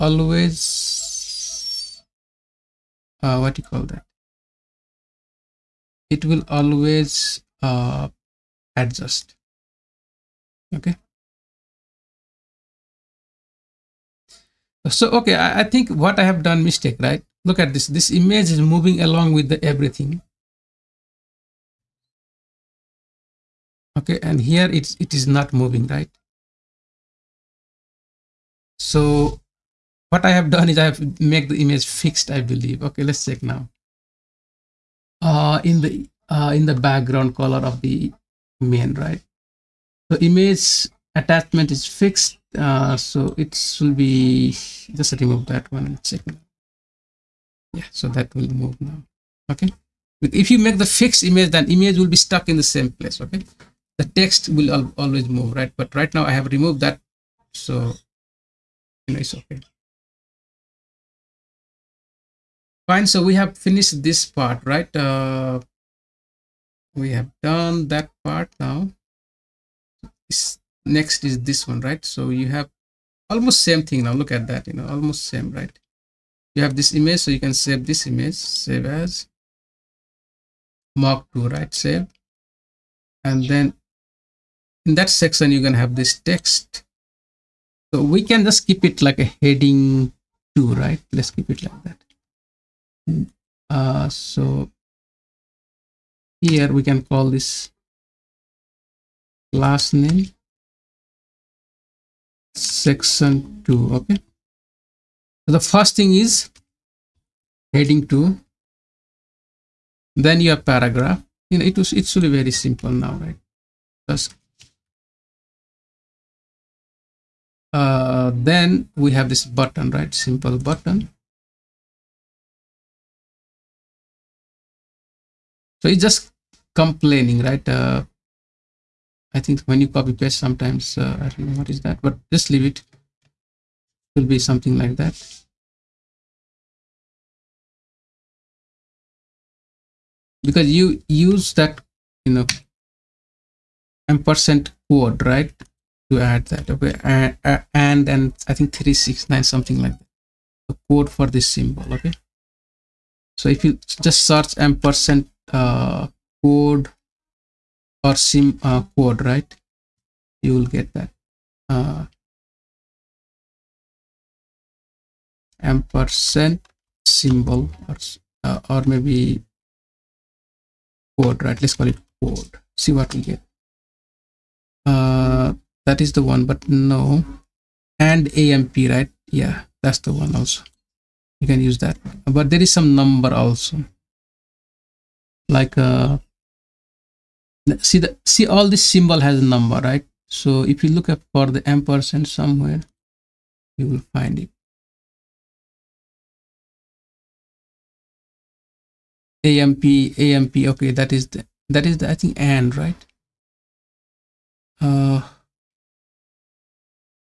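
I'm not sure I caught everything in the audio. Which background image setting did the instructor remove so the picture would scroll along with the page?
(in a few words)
image attachment.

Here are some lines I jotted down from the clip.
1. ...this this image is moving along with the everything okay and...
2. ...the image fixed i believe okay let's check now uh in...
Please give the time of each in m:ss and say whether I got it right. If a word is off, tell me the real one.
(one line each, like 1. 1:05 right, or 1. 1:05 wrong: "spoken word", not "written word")
1. 0:17 right
2. 0:31 right.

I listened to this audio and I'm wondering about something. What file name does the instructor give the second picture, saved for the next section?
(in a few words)
mark 2.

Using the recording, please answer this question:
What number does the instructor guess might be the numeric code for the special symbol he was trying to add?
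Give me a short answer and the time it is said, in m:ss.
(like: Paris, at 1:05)
369, at 2:28.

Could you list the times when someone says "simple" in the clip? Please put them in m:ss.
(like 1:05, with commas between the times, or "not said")
1:52, 2:00.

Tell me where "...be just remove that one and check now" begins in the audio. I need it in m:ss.
0:43.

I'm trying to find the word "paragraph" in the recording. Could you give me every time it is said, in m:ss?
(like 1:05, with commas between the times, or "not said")
1:50.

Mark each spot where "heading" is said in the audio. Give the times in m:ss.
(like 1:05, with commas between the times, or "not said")
1:29, 1:47.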